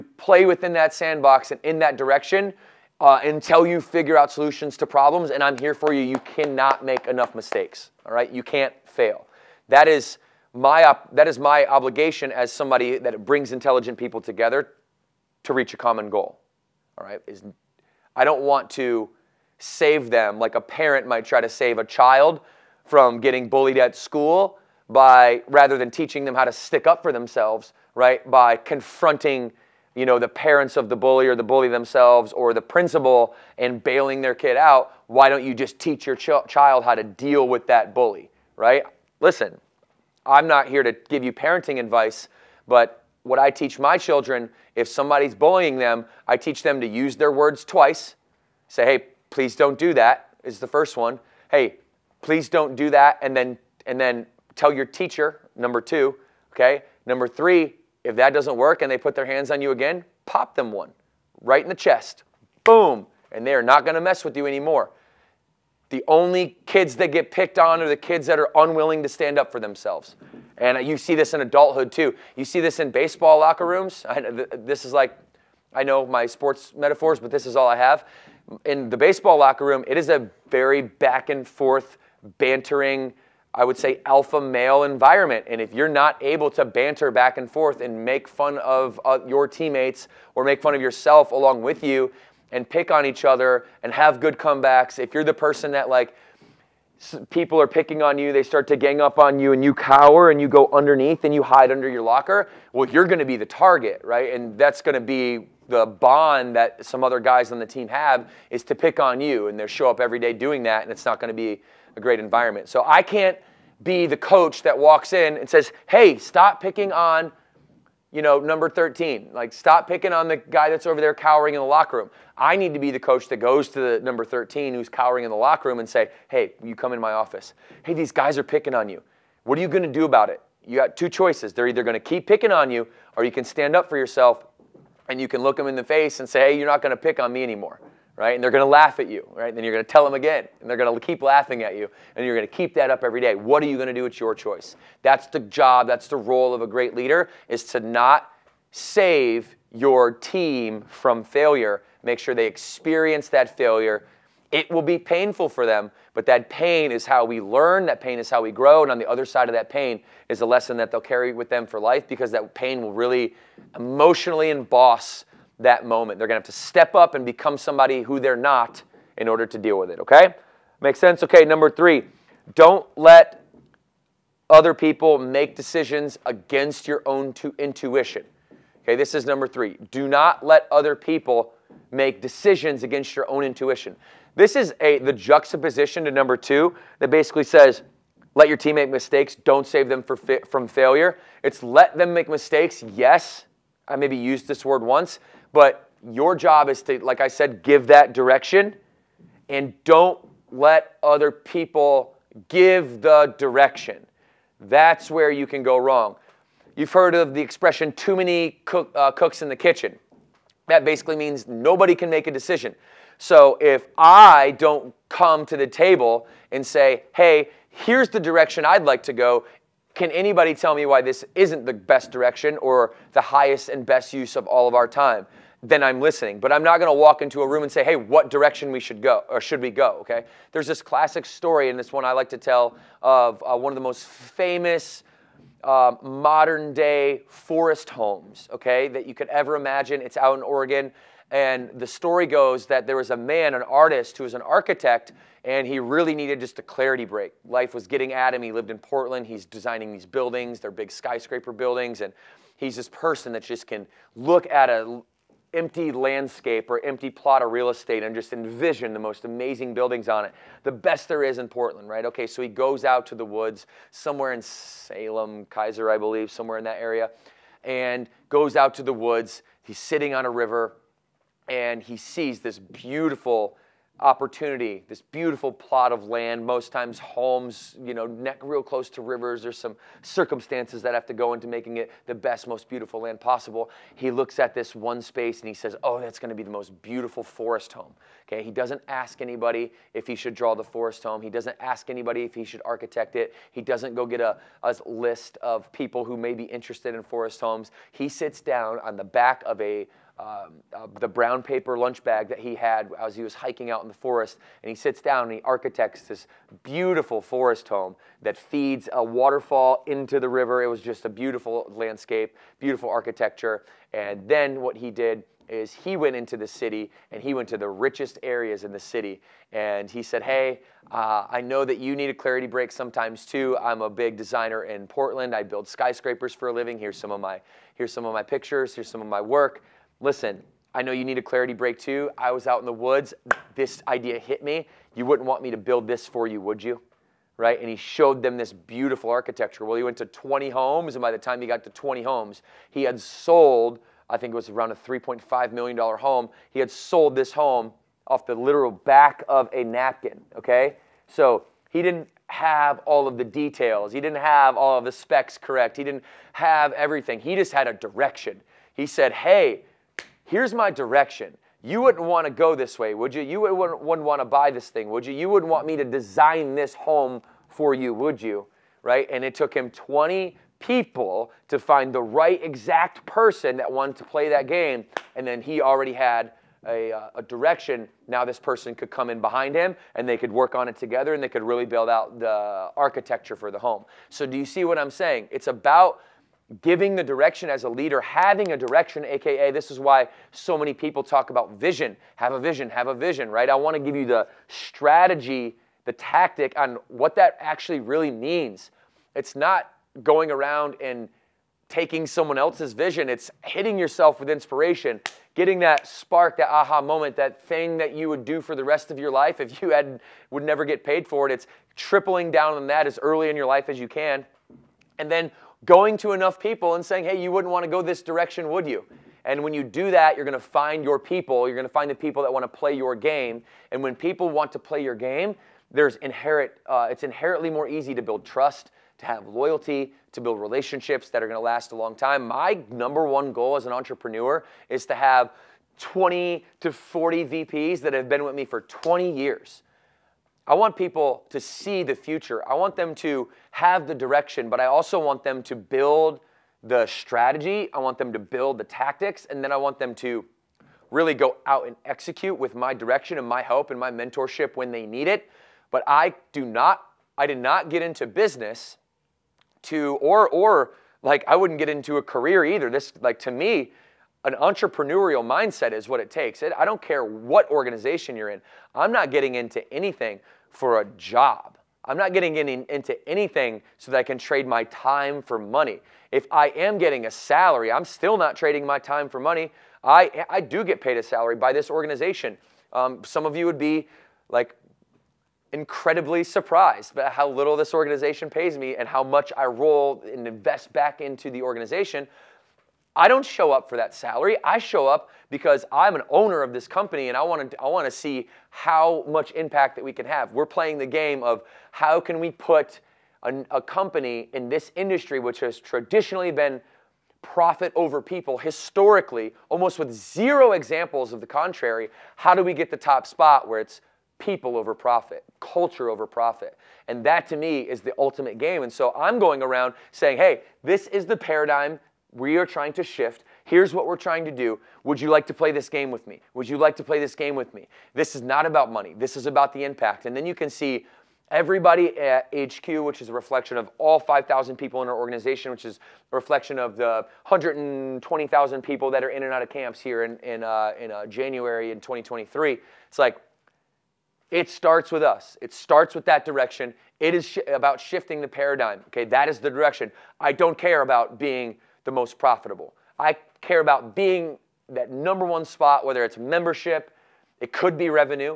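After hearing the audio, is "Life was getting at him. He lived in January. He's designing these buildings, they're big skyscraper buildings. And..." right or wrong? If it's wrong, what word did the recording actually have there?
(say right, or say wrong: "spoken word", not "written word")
wrong: "Portland", not "January".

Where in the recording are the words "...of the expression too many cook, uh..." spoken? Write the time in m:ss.
3:27.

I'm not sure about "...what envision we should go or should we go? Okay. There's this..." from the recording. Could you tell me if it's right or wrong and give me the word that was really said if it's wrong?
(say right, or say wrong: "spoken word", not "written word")
wrong: "direction", not "envision".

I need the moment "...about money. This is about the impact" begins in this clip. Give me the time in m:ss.
8:48.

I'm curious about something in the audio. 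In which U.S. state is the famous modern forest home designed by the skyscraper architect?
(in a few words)
Oregon.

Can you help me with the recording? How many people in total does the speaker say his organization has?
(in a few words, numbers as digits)
5,000.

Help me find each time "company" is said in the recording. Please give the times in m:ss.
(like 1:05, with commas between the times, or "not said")
8:16, 8:23.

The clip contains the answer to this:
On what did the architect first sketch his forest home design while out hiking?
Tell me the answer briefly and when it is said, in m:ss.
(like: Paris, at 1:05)
brown paper lunch bag, at 5:01.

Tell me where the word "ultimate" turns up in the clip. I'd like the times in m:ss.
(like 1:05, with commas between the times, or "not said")
8:37.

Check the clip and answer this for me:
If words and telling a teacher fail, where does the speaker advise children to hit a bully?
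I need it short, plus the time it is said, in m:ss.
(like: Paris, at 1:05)
chest, at 1:01.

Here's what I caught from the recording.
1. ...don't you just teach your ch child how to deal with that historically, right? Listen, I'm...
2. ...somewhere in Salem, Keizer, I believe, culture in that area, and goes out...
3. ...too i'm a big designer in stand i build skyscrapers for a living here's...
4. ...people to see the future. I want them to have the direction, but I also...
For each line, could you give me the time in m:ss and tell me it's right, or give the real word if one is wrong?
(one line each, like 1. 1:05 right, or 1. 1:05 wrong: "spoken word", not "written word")
1. 0:35 wrong: "bully", not "historically"
2. 4:23 wrong: "somewhere", not "culture"
3. 5:23 wrong: "portland", not "stand"
4. 7:20 right.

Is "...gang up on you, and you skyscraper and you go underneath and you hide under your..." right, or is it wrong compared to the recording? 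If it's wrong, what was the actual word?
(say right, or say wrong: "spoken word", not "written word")
wrong: "cower", not "skyscraper".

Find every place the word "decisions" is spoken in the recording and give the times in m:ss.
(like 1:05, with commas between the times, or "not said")
2:55, 3:02, 3:32.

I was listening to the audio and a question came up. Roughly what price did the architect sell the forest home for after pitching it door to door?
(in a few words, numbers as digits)
$3.5 million.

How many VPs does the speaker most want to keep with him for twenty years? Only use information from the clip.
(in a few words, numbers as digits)
20 to 40.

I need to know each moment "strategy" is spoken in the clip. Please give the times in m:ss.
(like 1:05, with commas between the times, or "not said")
6:34, 7:26.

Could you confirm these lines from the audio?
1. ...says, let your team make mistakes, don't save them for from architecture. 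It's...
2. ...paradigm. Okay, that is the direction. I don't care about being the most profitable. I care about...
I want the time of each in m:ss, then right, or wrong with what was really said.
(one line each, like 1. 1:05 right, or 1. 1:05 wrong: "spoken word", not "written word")
1. 3:07 wrong: "failure", not "architecture"
2. 9:08 right.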